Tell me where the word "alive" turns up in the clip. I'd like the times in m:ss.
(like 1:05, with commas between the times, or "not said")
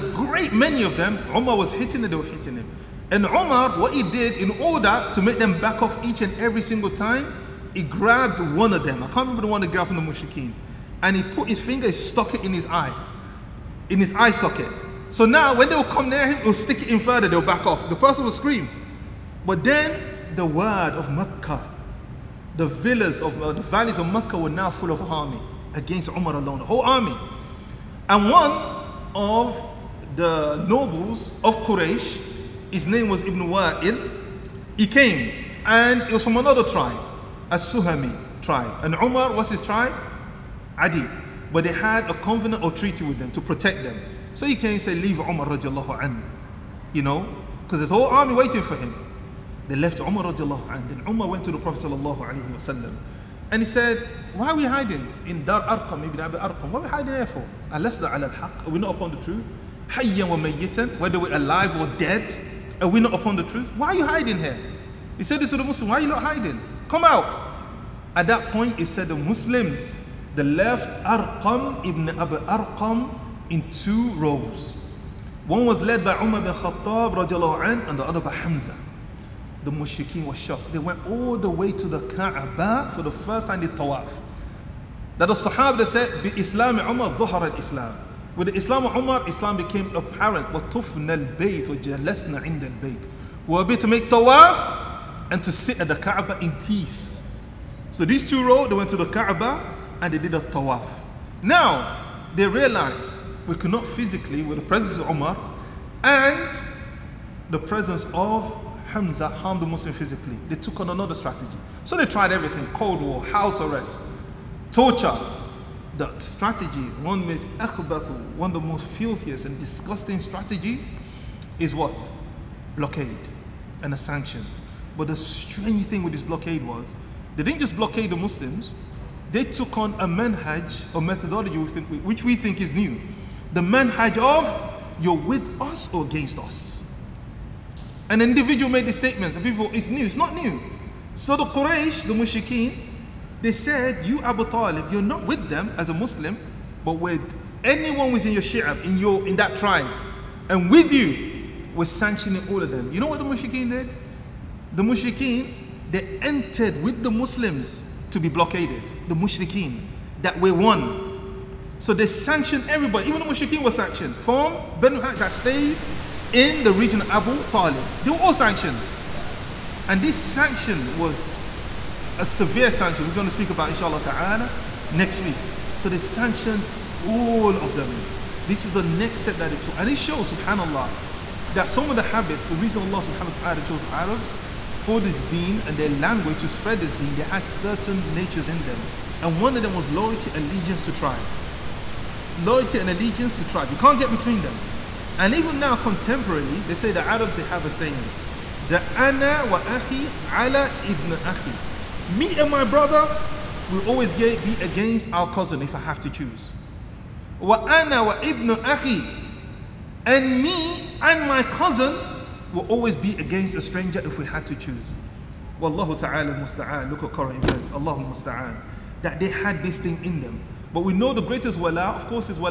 1:01.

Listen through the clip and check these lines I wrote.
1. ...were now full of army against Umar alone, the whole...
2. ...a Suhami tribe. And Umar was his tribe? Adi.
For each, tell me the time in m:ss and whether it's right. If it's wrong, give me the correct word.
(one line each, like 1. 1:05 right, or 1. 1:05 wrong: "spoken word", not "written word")
1. 0:24 right
2. 0:37 right.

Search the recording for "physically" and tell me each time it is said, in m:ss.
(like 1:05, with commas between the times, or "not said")
1:43, 1:49.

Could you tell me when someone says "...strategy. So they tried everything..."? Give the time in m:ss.
1:51.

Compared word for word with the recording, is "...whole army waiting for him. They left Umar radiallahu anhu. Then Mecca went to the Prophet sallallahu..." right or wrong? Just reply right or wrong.
wrong.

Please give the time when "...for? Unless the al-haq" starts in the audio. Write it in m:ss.
0:57.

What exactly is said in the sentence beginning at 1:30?
وَطُفْنَا الْبَيْتِ وَجَلَسْنَا عِنْدَ الْبَيْتِ We were able to make tawaf and to sit at the Kaaba in peace.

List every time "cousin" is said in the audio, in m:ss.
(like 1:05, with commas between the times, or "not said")
3:25, 3:31.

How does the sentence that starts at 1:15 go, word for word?
One was led by Umar bin Khattab an, and the other by Hamza.